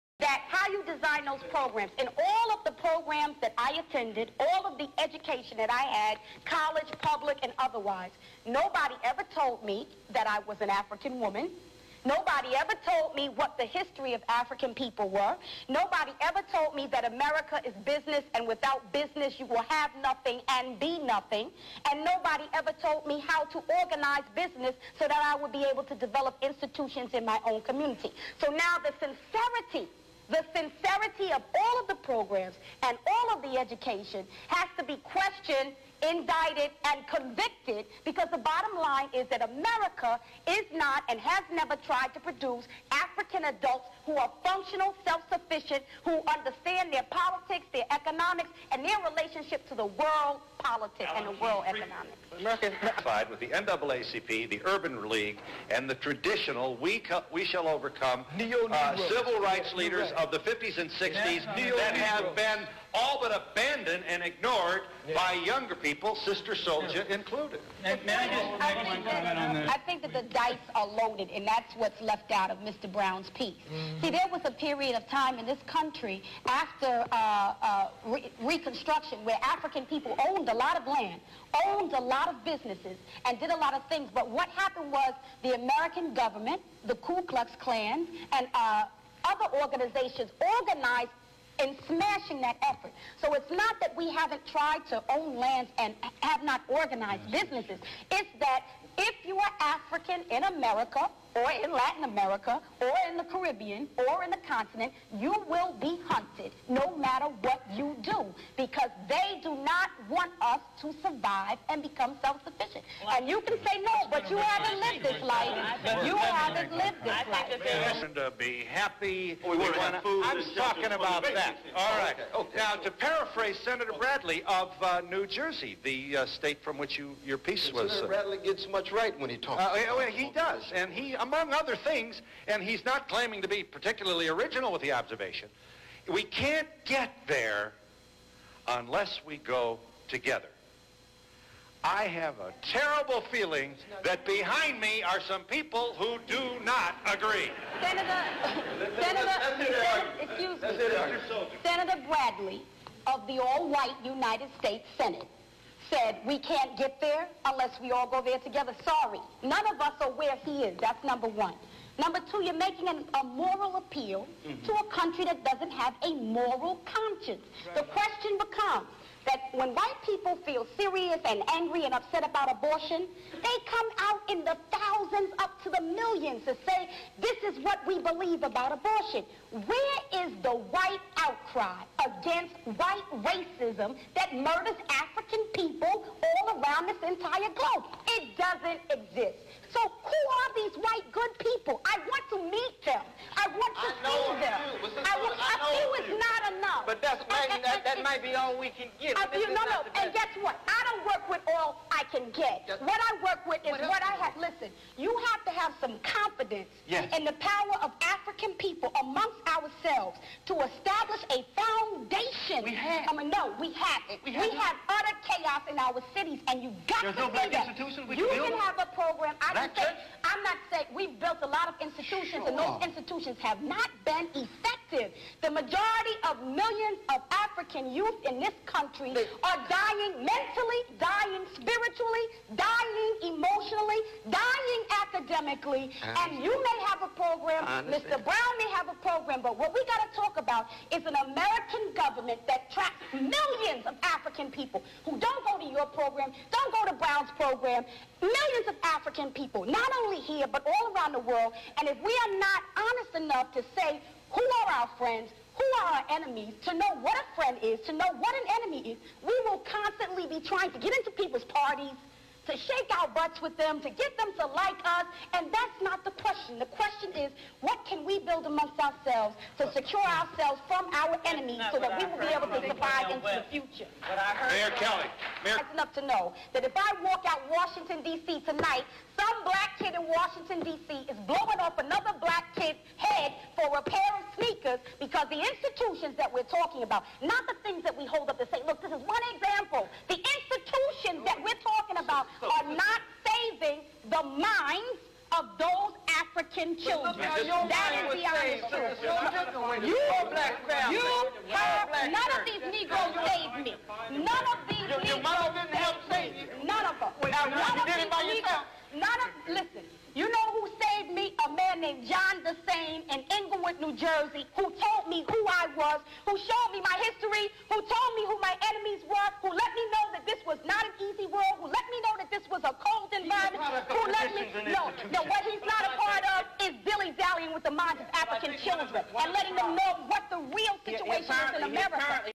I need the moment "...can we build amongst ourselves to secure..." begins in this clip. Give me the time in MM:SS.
04:27.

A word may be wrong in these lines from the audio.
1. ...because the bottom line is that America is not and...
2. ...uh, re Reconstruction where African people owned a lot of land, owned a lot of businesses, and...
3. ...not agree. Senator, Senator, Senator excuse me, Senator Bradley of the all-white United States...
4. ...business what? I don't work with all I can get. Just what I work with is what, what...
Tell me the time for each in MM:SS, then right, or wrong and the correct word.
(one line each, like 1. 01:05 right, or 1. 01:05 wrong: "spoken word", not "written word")
1. 00:38 right
2. 01:17 right
3. 02:26 right
4. 03:20 wrong: "guess", not "business".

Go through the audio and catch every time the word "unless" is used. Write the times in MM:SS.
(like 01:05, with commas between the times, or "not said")
02:18, 02:37.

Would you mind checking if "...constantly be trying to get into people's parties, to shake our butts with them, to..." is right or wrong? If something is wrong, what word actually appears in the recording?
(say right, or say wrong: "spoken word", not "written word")
right.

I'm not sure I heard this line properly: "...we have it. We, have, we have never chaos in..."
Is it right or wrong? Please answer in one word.
wrong.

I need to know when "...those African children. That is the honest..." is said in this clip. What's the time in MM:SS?
04:55.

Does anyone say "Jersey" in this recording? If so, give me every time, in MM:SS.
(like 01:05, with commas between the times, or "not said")
02:05, 05:13.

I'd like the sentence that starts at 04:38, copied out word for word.
tonight, some black kid in Washington, D.C.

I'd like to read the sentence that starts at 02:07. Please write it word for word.
Senator uh, Bradley gets much right when he talks.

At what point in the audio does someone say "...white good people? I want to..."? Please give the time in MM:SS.
03:10.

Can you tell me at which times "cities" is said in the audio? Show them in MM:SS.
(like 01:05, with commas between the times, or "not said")
03:36.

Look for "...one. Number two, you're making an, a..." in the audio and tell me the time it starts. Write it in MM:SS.
02:41.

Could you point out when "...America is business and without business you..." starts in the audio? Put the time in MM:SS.
00:17.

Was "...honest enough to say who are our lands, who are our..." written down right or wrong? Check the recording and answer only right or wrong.
wrong.